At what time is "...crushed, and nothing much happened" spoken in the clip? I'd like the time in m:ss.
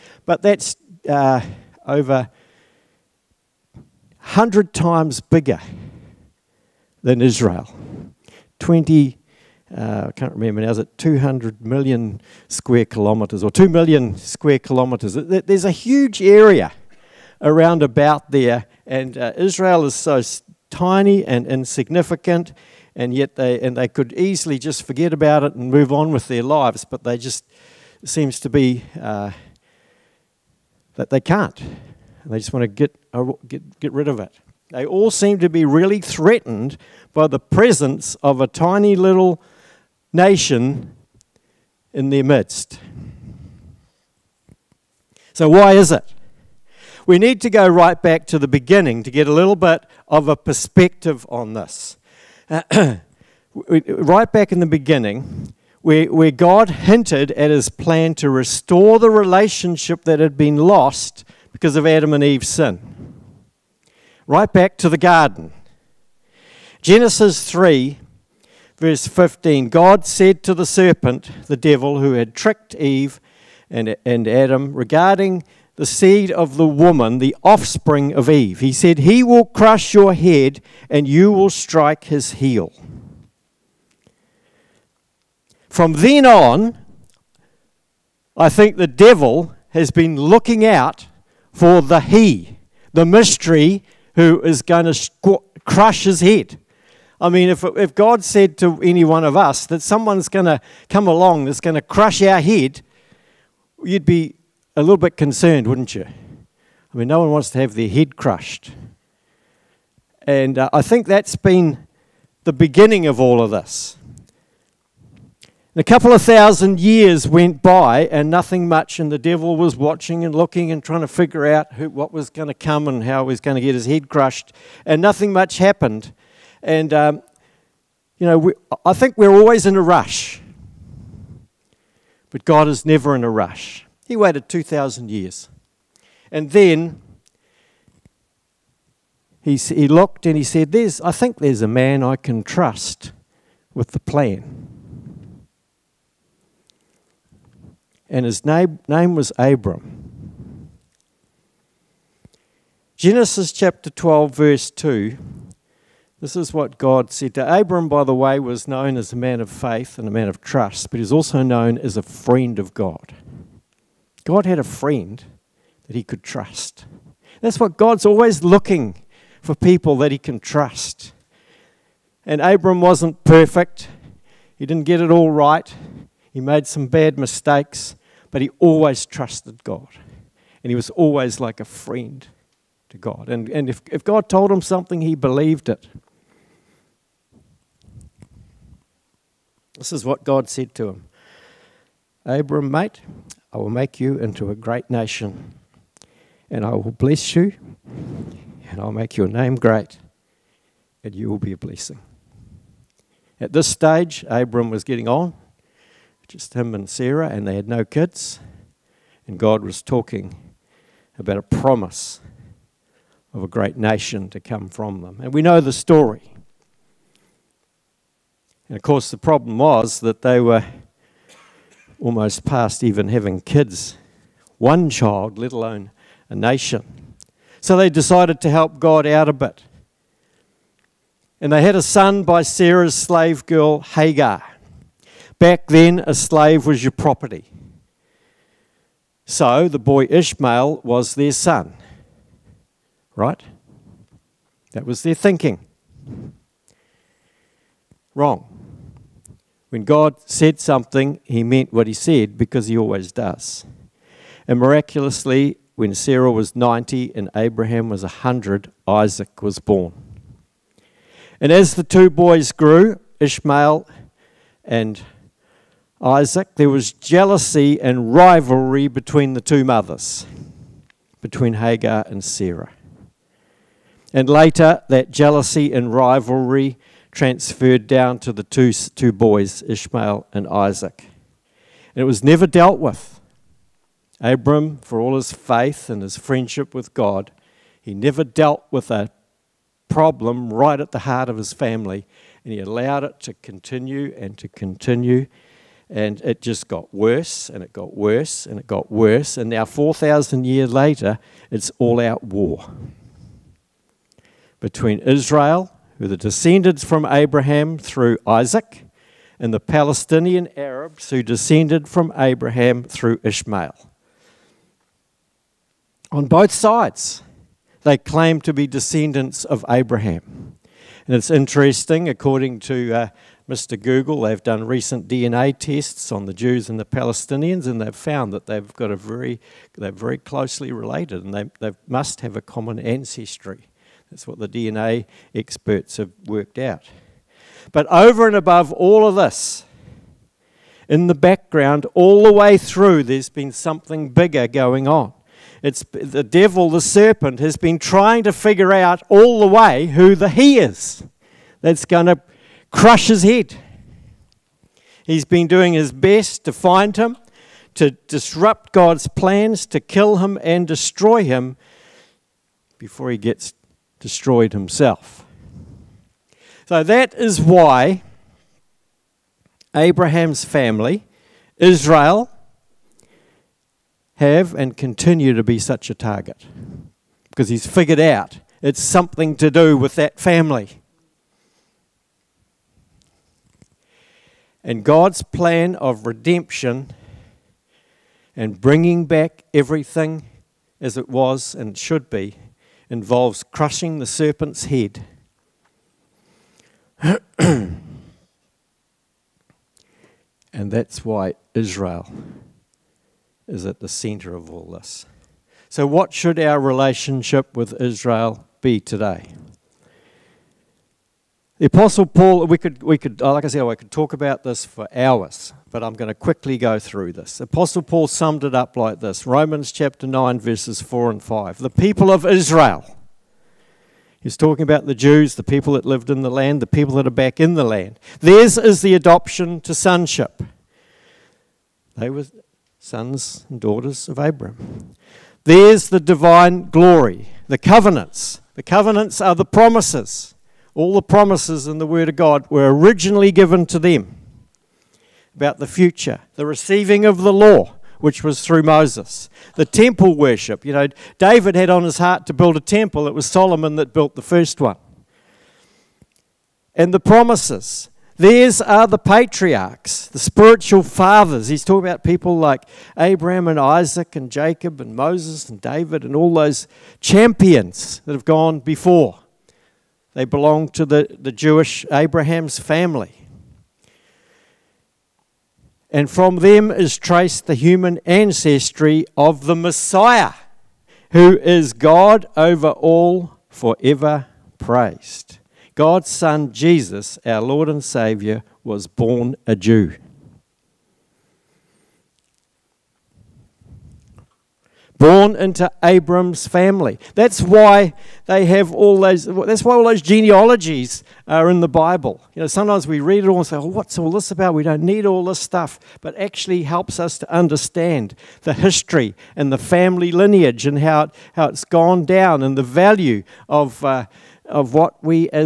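2:04.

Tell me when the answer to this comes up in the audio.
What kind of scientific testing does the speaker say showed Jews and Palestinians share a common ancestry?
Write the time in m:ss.
5:25.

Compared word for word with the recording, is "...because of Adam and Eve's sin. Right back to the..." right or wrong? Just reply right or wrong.
right.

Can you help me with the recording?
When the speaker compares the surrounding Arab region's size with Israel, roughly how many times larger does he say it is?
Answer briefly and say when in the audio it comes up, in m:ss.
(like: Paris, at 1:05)
over 100 times, at 0:01.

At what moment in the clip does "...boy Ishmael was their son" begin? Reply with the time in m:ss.
3:59.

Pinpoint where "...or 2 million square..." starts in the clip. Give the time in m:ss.
0:13.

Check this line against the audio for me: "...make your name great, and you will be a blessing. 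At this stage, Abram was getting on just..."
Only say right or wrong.
right.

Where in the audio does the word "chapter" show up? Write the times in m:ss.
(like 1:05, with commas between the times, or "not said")
2:33, 6:59.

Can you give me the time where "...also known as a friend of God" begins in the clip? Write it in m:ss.
2:41.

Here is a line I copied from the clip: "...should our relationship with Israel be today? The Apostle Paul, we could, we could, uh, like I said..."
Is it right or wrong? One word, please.
right.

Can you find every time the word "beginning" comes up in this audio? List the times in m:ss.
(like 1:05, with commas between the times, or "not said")
0:48, 0:54, 1:52.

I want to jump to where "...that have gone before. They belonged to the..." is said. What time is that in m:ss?
7:48.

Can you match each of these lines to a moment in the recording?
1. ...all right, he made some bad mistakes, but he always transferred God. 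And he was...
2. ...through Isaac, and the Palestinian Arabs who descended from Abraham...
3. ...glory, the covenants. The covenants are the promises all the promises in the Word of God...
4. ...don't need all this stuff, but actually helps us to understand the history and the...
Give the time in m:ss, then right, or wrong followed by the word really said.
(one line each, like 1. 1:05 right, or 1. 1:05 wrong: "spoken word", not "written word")
1. 2:55 wrong: "trusted", not "transferred"
2. 5:07 right
3. 7:16 right
4. 8:24 right.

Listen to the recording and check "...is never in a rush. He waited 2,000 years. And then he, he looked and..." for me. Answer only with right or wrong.
right.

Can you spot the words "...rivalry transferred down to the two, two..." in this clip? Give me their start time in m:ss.
4:35.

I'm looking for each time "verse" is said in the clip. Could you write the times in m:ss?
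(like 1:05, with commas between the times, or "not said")
1:08, 2:34, 7:00.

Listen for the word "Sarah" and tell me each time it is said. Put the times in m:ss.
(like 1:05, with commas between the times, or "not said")
3:26, 3:52, 4:15, 4:32.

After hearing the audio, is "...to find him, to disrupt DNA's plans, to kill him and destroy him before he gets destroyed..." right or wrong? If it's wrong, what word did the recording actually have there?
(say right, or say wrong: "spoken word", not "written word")
wrong: "God", not "DNA".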